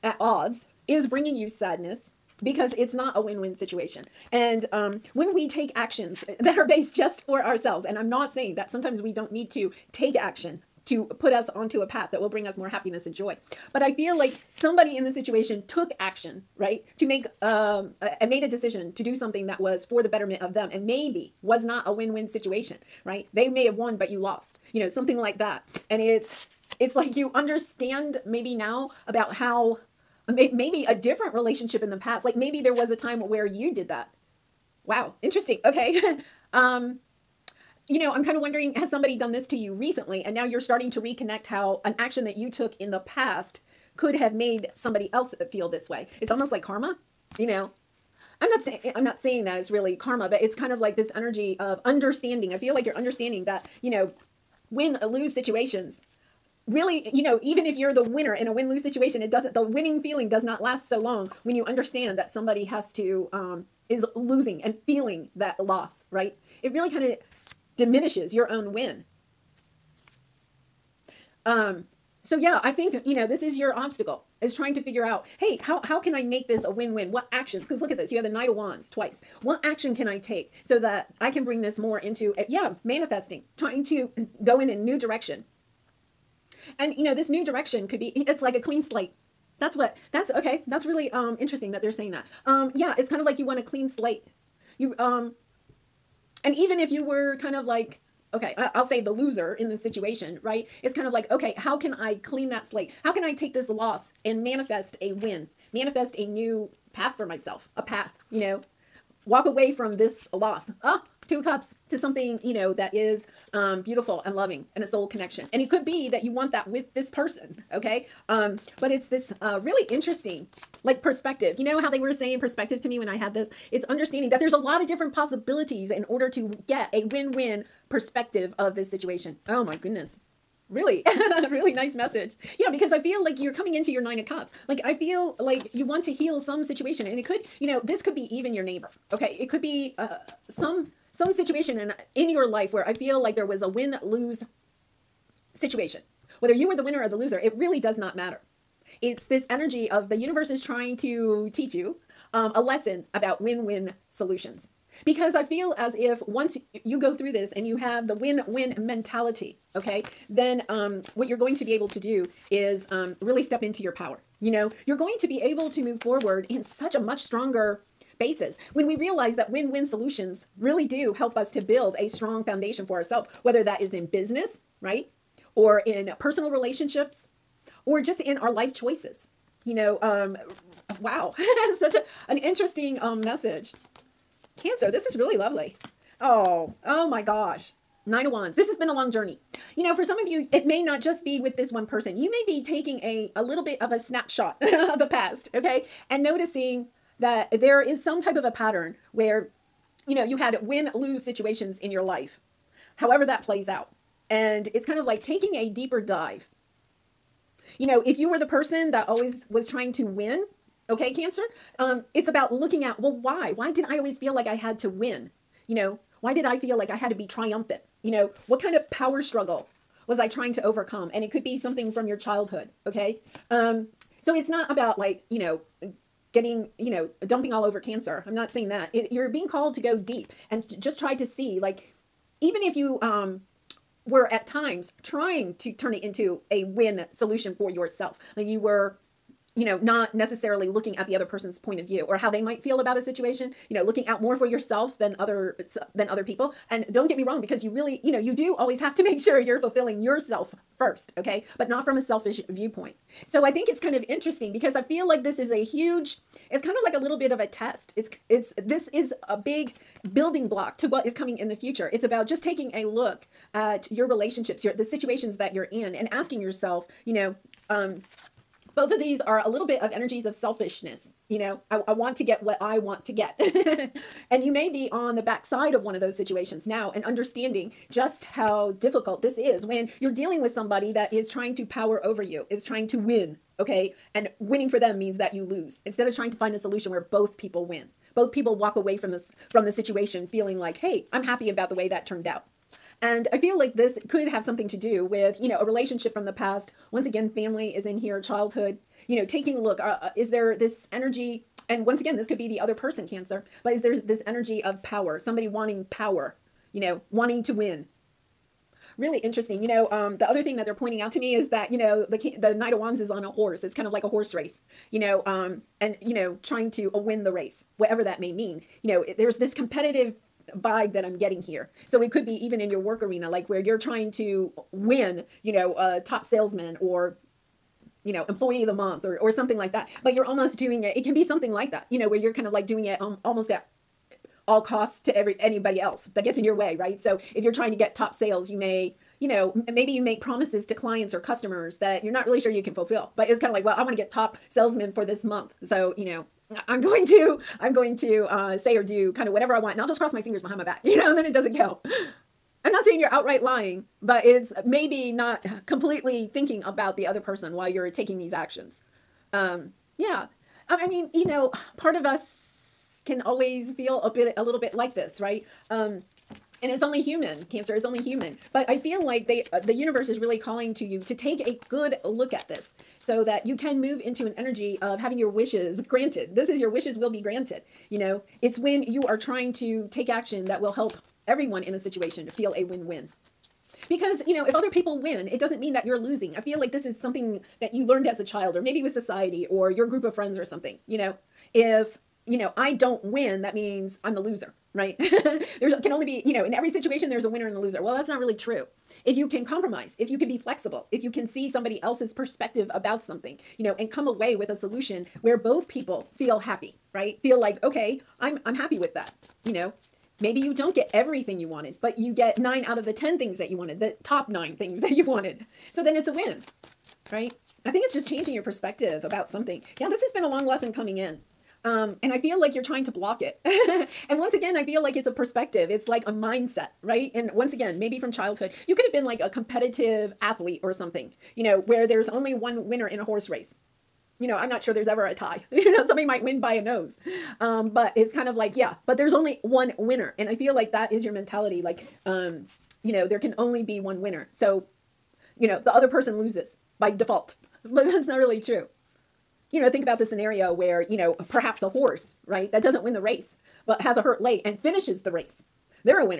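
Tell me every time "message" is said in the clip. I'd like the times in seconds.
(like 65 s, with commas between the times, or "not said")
131 s, 183 s.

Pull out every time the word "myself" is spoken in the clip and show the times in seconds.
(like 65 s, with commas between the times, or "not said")
107 s.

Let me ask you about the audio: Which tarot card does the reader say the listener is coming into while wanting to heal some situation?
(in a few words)
Nine of Cups.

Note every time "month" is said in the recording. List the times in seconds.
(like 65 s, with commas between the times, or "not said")
328 s, 345 s.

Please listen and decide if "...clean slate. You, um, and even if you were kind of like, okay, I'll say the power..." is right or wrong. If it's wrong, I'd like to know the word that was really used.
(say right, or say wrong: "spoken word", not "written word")
wrong: "loser", not "power".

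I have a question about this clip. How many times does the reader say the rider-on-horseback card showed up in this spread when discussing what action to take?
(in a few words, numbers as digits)
twice.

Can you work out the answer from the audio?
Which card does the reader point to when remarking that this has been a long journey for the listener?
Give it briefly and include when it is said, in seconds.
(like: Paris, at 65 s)
Nine of Wands, at 188 s.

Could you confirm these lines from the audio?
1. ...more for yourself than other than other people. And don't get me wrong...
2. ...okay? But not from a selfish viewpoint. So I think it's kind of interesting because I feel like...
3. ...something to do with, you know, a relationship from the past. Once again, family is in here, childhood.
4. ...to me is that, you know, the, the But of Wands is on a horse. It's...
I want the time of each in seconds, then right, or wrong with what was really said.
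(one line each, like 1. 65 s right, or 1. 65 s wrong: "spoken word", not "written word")
1. 244 s right
2. 251 s right
3. 294 s right
4. 311 s wrong: "Knight", not "But".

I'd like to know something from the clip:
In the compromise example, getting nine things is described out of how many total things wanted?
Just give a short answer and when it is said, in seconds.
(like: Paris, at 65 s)
10, at 412 s.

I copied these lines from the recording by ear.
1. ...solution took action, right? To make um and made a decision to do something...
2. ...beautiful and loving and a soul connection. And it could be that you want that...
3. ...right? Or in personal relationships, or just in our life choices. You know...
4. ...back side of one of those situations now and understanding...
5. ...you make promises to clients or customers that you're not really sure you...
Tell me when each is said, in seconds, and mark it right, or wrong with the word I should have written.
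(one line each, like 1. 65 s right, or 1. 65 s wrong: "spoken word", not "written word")
1. 15 s wrong: "situation", not "solution"
2. 113 s right
3. 174 s right
4. 275 s right
5. 339 s right.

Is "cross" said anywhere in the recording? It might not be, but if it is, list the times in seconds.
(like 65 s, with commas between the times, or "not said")
349 s.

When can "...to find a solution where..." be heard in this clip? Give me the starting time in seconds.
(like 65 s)
286 s.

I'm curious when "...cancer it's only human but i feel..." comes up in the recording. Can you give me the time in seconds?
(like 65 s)
367 s.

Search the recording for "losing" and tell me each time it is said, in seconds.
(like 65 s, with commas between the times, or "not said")
64 s, 385 s.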